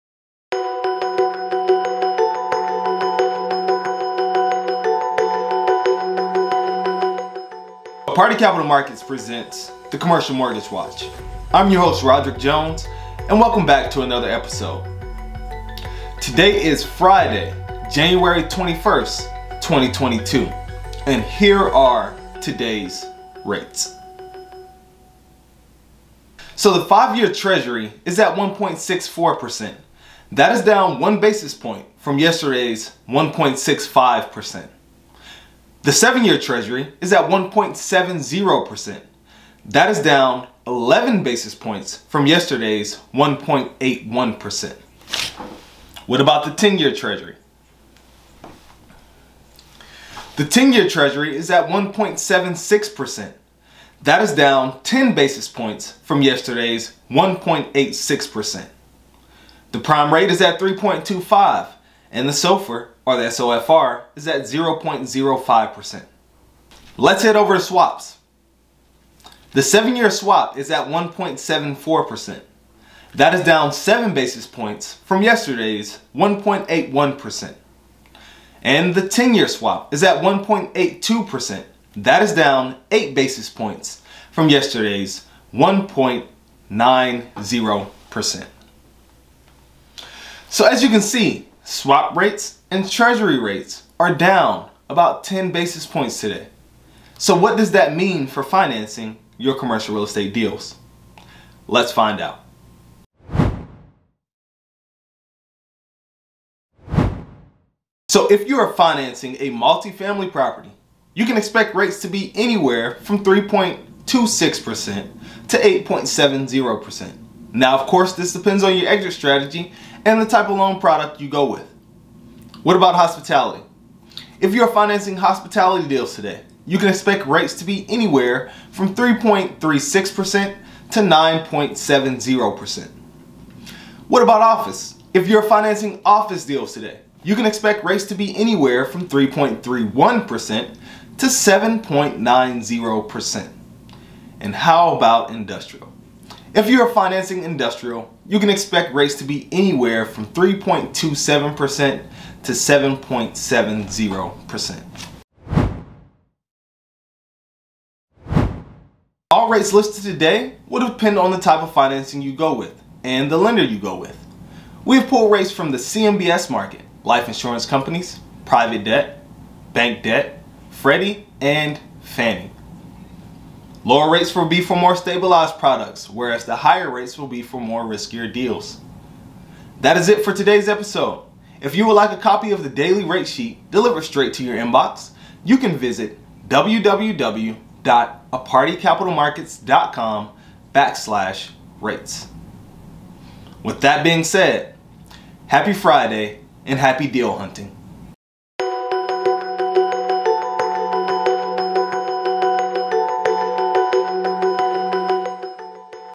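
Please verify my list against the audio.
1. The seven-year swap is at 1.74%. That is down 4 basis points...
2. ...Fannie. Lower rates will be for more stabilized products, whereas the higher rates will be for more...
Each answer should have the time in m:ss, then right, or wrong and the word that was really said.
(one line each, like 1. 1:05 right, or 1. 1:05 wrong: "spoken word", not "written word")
1. 1:09 wrong: "7", not "4"
2. 2:51 right.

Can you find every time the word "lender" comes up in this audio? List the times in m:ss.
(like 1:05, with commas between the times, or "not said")
2:43.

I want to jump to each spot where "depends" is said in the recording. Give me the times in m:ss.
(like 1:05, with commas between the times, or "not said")
1:58, 2:40.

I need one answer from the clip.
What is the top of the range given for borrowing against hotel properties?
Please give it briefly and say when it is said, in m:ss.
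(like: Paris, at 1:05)
9.70%, at 2:10.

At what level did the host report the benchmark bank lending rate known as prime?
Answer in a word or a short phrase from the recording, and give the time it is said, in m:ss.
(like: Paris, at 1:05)
3.25, at 1:00.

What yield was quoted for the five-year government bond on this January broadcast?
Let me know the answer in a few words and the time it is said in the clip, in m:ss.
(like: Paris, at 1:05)
1.64%, at 0:28.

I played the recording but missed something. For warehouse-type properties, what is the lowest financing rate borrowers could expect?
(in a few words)
3.27%.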